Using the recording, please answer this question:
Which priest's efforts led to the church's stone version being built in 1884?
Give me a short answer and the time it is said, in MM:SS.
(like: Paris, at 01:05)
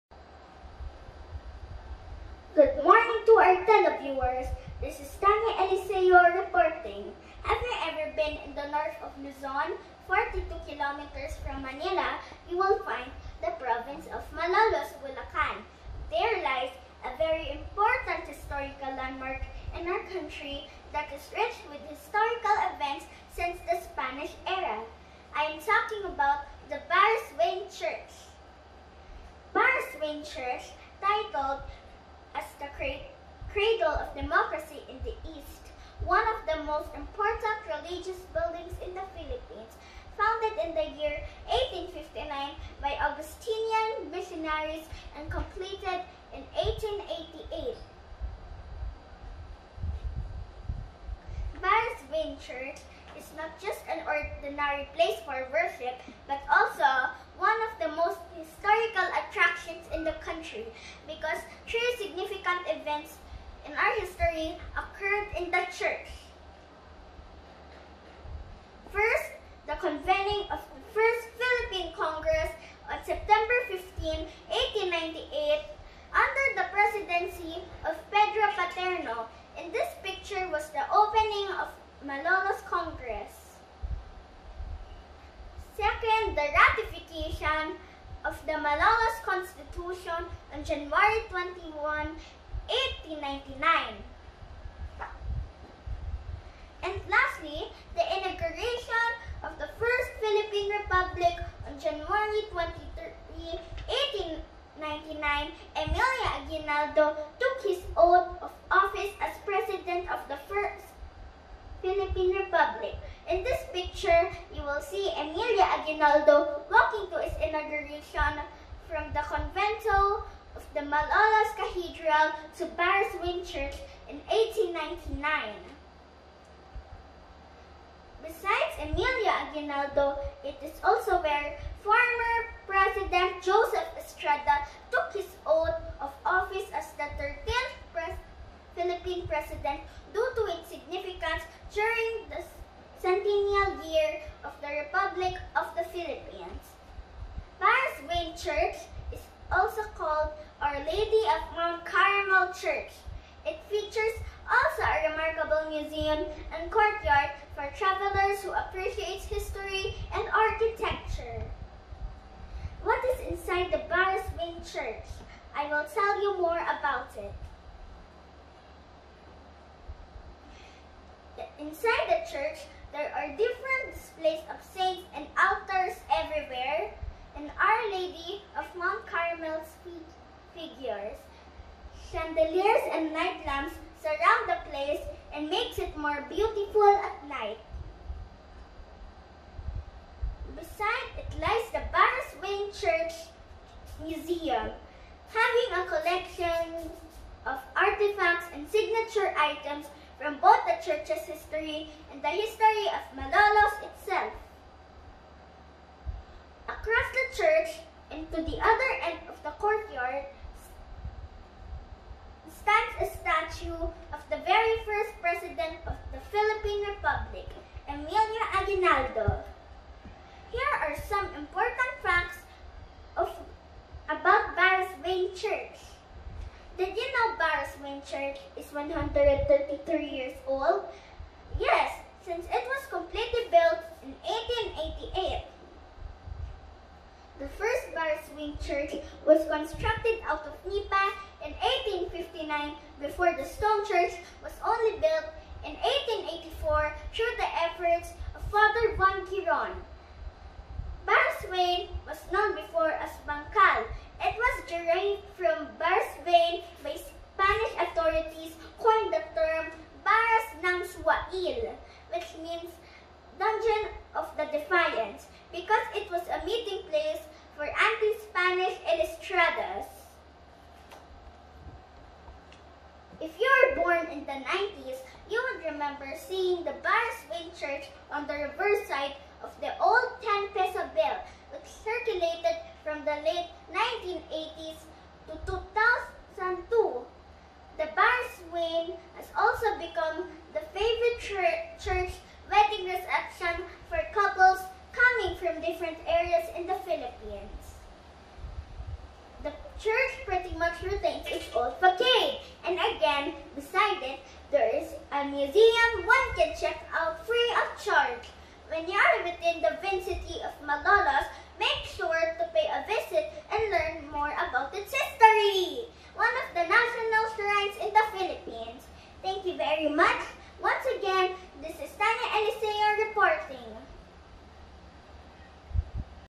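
Father Juan Giron, at 04:08.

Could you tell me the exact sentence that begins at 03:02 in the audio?
Chandeliers and night lamps surround the place and makes it more beautiful at night.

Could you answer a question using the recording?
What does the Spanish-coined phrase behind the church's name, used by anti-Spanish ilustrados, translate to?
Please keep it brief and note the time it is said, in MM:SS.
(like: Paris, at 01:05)
Dungeon of the Defiance, at 04:23.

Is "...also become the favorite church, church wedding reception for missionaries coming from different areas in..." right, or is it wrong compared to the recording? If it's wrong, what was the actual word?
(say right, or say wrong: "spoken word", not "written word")
wrong: "couples", not "missionaries".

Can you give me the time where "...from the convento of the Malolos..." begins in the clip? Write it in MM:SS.
01:58.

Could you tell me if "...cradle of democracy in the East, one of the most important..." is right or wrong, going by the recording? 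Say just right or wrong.
right.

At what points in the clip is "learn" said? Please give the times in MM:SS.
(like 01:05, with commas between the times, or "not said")
05:13.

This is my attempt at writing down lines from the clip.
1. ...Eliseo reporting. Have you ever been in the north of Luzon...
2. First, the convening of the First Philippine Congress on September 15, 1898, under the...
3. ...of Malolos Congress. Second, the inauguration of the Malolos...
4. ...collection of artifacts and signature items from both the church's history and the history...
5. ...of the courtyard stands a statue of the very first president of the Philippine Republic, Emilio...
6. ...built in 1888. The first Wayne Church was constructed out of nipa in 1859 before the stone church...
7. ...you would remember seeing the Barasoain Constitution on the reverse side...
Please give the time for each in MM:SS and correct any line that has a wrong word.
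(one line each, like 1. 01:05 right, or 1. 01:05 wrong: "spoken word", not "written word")
1. 00:05 right
2. 01:08 right
3. 01:21 wrong: "ratification", not "inauguration"
4. 03:15 right
5. 03:29 right
6. 03:53 right
7. 04:35 wrong: "Church", not "Constitution".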